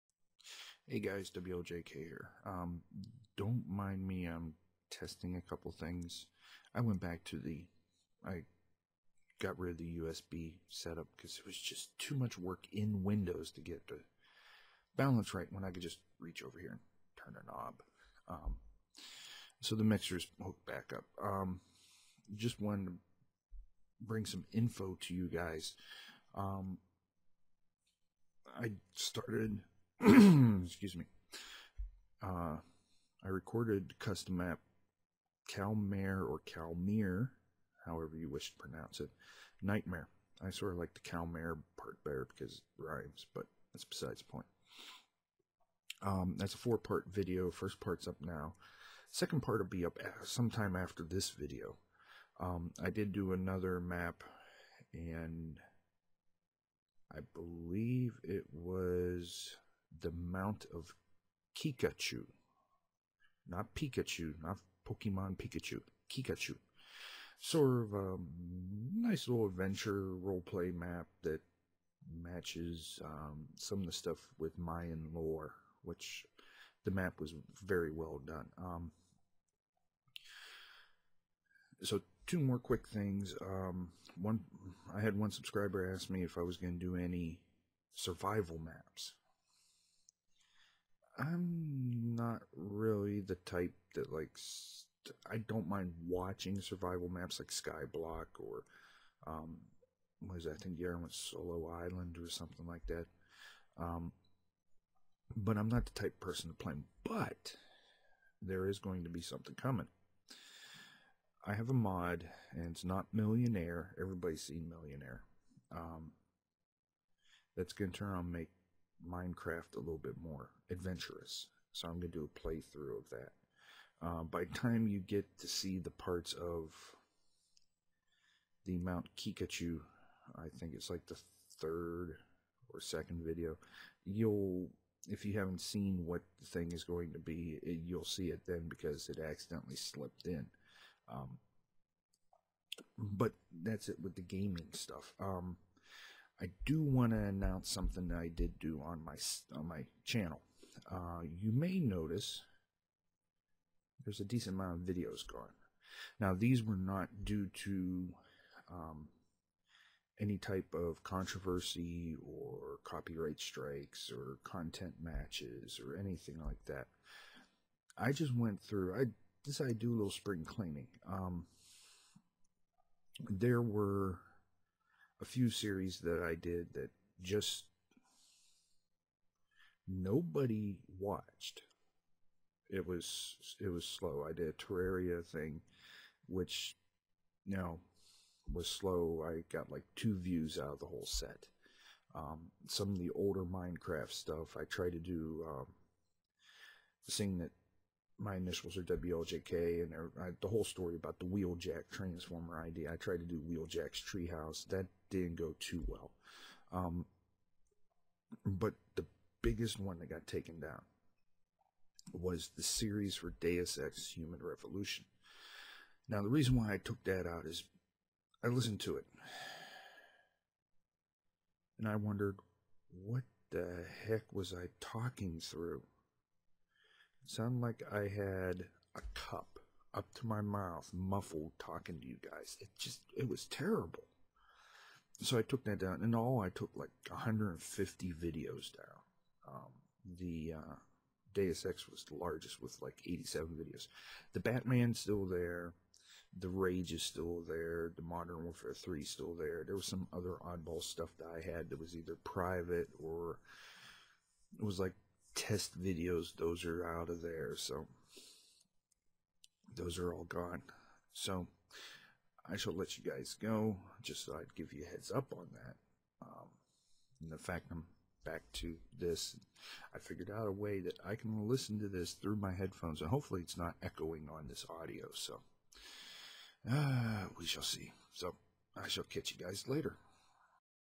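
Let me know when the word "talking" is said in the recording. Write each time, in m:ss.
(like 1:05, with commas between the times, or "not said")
3:44, 3:51.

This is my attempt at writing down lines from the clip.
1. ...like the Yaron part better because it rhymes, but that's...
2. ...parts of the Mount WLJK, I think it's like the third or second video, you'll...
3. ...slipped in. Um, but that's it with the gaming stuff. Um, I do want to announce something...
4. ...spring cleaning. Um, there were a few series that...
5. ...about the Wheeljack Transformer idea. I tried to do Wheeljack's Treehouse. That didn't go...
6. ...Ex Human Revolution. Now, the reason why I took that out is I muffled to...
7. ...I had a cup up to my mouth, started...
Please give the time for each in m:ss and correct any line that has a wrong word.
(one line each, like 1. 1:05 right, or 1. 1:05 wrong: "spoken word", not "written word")
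1. 0:40 wrong: "Calmare", not "Yaron"
2. 2:05 wrong: "Kikachu", not "WLJK"
3. 2:19 right
4. 2:50 right
5. 3:20 right
6. 3:33 wrong: "listened", not "muffled"
7. 3:47 wrong: "muffled", not "started".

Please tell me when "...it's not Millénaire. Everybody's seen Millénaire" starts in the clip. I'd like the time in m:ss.
1:52.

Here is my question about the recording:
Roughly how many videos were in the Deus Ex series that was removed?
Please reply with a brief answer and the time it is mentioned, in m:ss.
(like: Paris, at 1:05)
87, at 4:03.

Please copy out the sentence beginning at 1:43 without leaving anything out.
Um, but I'm not the type person to play.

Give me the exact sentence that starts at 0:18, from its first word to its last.
Um, so the mixer's hooked back up.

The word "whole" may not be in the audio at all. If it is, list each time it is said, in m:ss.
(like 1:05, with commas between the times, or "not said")
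3:10, 3:20.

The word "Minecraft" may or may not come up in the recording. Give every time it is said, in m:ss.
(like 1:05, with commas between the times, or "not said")
1:59, 3:13.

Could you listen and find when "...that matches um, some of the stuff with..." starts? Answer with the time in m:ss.
1:11.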